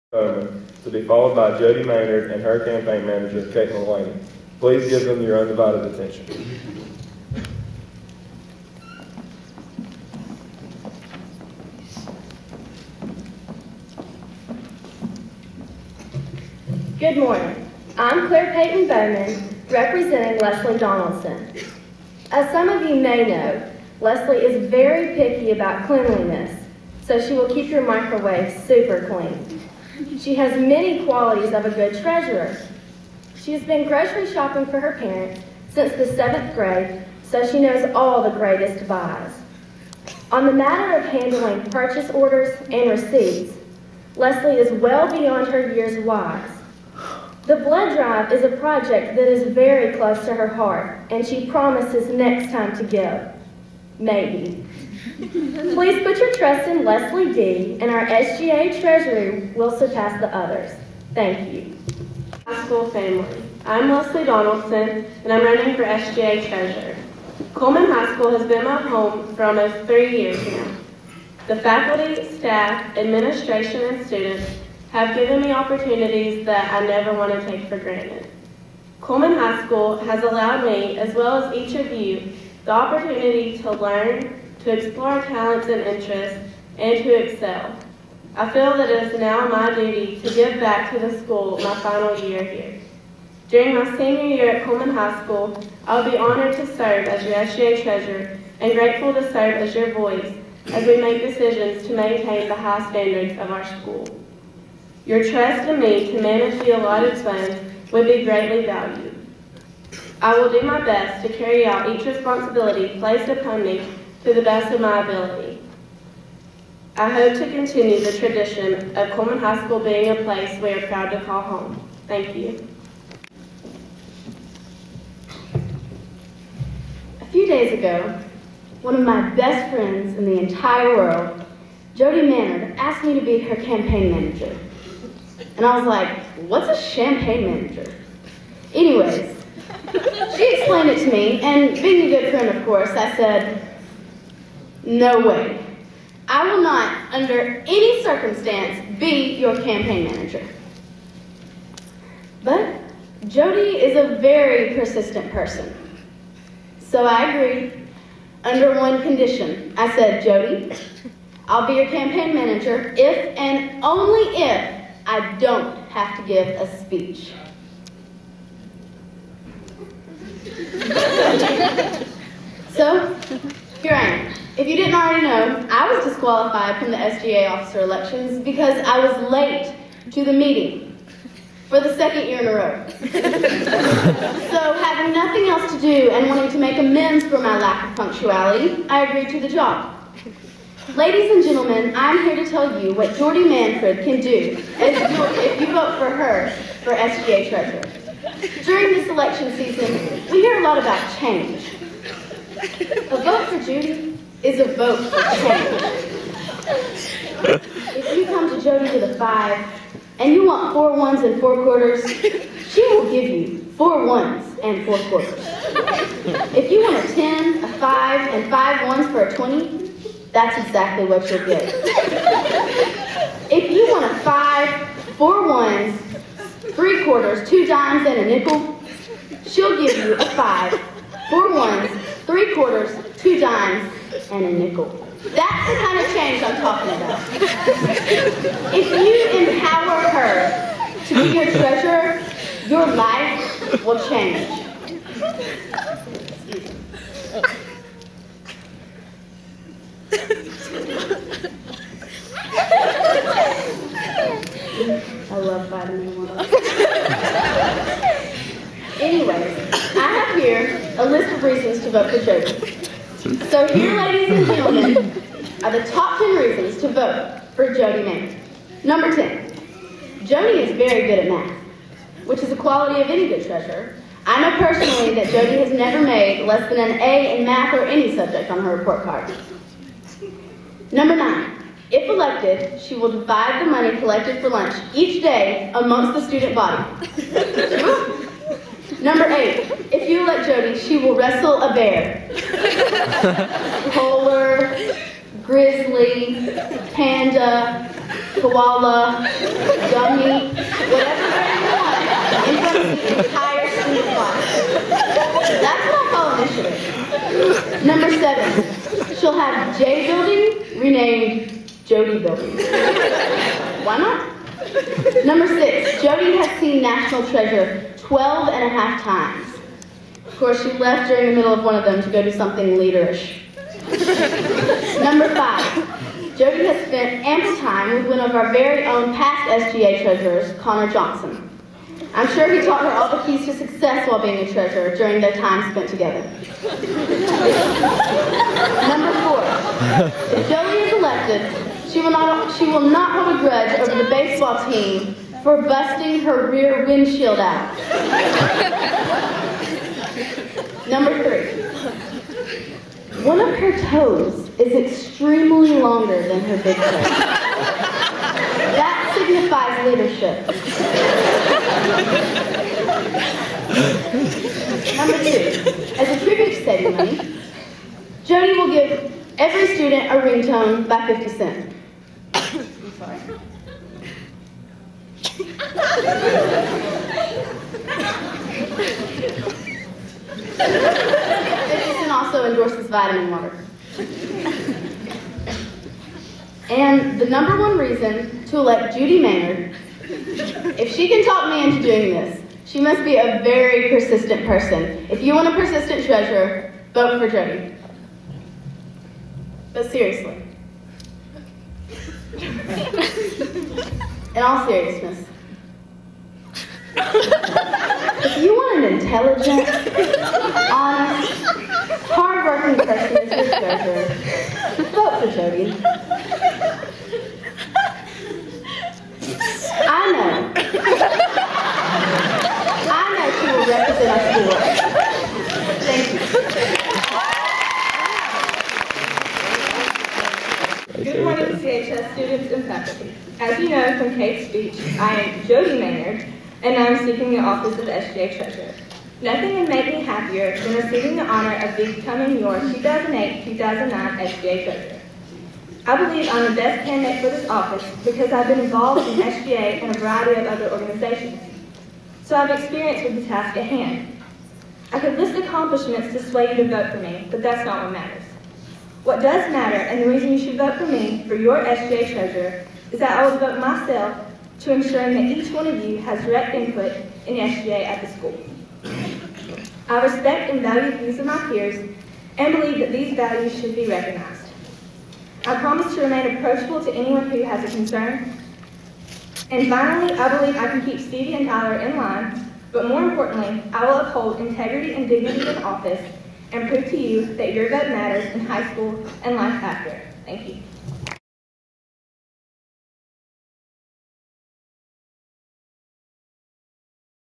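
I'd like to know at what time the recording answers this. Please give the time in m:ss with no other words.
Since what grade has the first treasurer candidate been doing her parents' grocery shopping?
0:36.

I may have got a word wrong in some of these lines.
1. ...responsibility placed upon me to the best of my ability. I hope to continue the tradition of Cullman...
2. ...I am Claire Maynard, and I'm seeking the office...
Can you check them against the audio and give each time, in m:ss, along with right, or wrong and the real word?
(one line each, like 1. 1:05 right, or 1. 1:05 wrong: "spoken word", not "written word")
1. 1:52 right
2. 7:14 wrong: "Jody", not "Claire".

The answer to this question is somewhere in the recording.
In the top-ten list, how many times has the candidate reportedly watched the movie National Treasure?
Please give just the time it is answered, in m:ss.
5:17.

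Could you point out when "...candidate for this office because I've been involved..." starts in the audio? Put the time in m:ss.
7:26.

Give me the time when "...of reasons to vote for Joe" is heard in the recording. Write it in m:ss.
4:21.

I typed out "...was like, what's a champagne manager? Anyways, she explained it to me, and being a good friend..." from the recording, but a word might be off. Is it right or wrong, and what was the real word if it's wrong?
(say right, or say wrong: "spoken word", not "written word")
right.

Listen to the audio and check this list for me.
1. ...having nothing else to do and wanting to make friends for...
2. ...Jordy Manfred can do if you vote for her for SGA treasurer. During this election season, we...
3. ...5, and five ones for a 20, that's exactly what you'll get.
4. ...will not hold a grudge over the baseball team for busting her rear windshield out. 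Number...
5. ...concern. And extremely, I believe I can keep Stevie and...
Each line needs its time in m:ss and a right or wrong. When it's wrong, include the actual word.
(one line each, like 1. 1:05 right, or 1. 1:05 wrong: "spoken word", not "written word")
1. 3:04 wrong: "amends", not "friends"
2. 3:13 right
3. 3:37 right
4. 5:42 right
5. 7:57 wrong: "finally", not "extremely".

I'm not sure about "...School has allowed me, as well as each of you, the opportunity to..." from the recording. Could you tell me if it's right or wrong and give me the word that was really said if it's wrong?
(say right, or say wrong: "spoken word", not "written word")
right.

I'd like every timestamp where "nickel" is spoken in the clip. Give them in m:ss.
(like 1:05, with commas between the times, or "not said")
3:48, 3:54.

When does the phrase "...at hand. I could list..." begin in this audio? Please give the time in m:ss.
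7:33.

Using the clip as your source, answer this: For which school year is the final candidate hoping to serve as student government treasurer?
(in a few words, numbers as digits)
2008-2009.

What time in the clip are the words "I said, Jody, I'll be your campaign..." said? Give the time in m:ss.
2:39.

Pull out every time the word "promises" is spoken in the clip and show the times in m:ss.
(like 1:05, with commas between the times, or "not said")
0:51, 7:55.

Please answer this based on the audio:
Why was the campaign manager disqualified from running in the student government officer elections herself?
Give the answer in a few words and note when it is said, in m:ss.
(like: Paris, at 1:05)
late to the meeting, at 2:59.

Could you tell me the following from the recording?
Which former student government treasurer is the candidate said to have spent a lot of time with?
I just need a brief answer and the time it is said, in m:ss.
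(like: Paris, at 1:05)
Connor Johnson, at 5:30.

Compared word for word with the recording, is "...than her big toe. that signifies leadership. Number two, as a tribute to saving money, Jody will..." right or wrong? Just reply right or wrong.
right.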